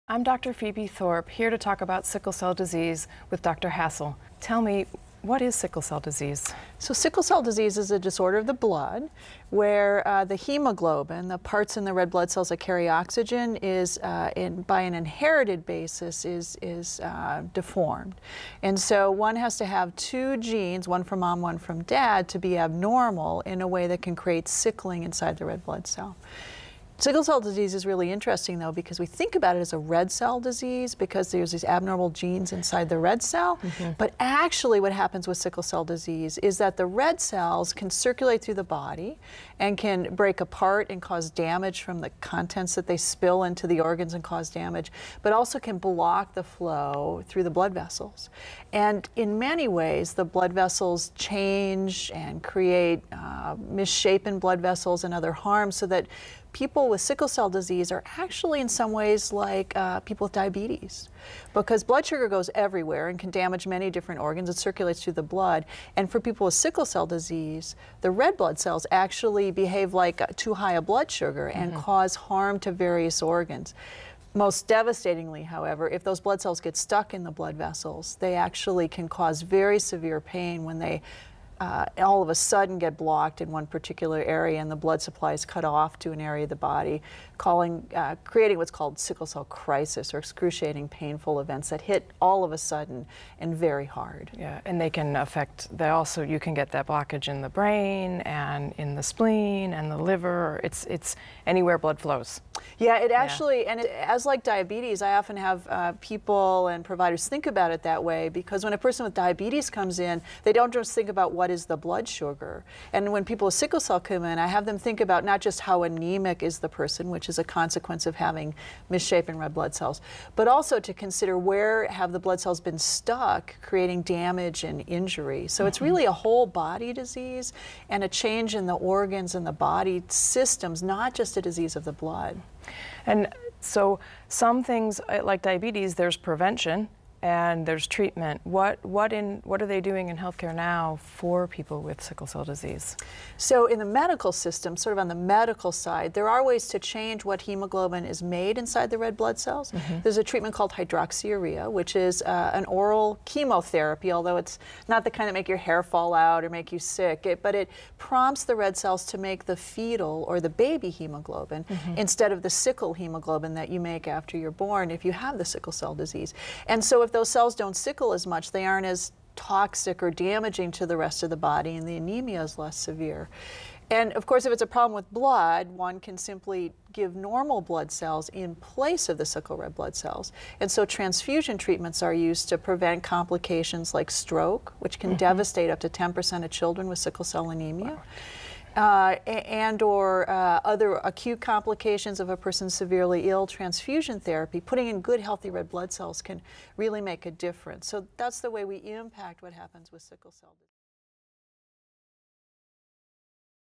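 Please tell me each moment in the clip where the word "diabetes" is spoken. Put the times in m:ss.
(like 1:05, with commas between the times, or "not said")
1:00, 1:44, 1:49, 2:15.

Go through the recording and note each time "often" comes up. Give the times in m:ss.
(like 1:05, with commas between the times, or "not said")
1:45.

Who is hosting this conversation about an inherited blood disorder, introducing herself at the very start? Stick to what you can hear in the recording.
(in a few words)
Phoebe Thorpe.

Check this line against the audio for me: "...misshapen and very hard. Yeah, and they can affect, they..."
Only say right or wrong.
wrong.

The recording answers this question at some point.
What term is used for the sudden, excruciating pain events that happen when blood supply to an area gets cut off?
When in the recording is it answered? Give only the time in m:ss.
1:28.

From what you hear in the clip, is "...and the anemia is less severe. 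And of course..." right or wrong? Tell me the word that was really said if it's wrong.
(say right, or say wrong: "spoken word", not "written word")
right.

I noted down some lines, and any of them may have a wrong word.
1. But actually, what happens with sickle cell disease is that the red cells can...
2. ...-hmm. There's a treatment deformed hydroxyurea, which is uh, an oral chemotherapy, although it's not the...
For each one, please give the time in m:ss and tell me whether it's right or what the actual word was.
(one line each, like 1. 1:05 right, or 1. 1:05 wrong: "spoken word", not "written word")
1. 0:33 right
2. 2:29 wrong: "called", not "deformed".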